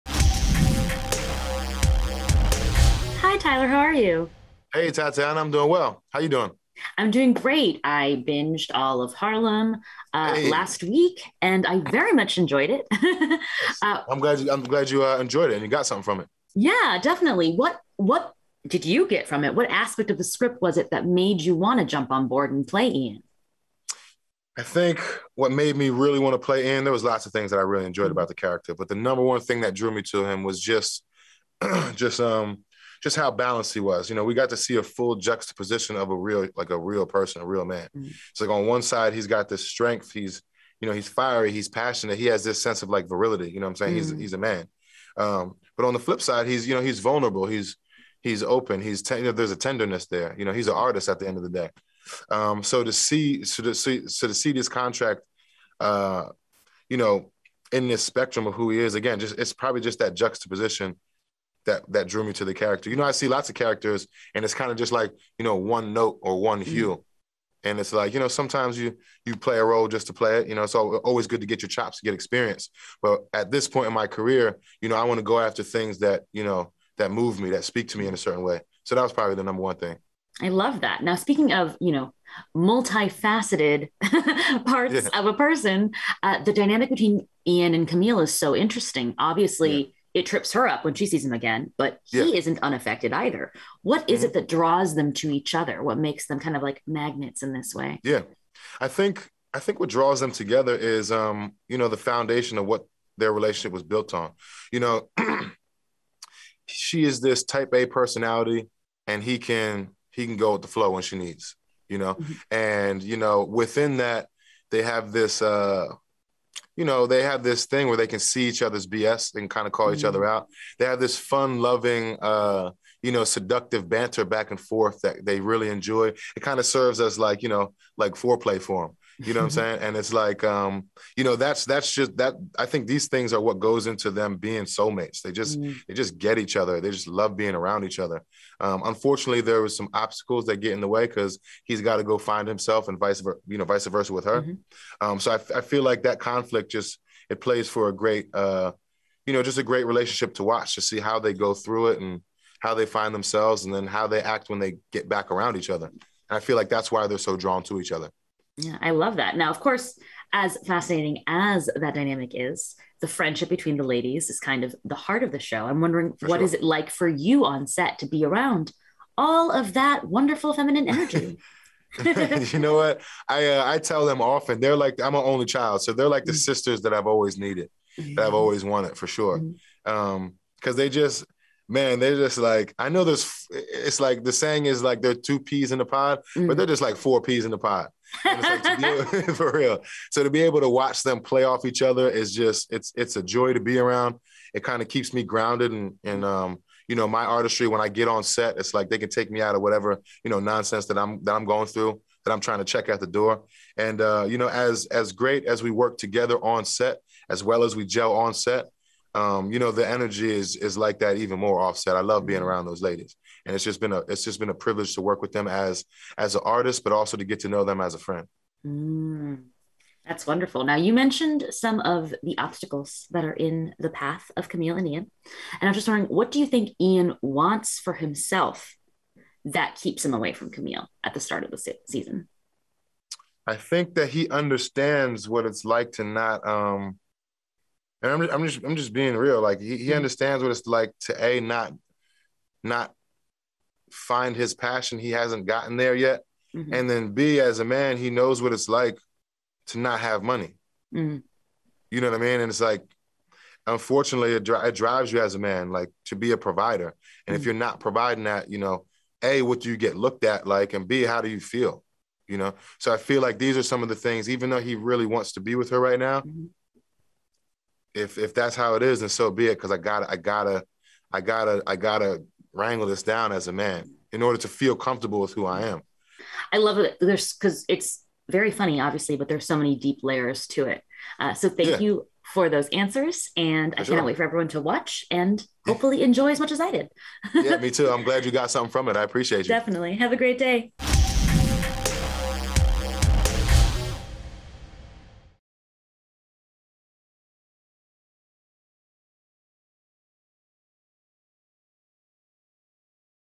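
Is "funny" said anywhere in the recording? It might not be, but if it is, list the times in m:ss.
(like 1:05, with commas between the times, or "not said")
4:38.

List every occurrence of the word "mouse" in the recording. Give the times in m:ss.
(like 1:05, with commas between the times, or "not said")
not said.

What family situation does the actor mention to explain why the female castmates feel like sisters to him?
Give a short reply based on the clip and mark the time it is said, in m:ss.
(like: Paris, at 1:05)
only child, at 2:55.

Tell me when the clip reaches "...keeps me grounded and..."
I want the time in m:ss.
3:14.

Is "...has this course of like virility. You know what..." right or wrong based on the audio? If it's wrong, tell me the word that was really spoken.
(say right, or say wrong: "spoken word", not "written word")
wrong: "sense", not "course".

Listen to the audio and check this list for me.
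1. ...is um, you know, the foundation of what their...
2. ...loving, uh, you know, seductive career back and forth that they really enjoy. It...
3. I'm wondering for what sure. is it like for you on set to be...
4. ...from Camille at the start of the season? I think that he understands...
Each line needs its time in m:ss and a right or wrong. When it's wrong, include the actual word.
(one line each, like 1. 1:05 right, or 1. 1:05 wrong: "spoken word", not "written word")
1. 1:40 right
2. 2:01 wrong: "banter", not "career"
3. 2:45 right
4. 3:50 right.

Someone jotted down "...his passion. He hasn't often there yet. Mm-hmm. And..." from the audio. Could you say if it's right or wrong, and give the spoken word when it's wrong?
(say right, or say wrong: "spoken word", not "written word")
wrong: "gotten", not "often".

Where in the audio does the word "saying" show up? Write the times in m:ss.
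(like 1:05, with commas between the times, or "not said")
0:43, 2:09, 3:04.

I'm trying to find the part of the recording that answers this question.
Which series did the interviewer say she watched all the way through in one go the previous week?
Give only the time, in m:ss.
0:09.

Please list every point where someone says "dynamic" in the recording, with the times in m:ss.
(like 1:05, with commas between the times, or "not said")
1:26, 2:41.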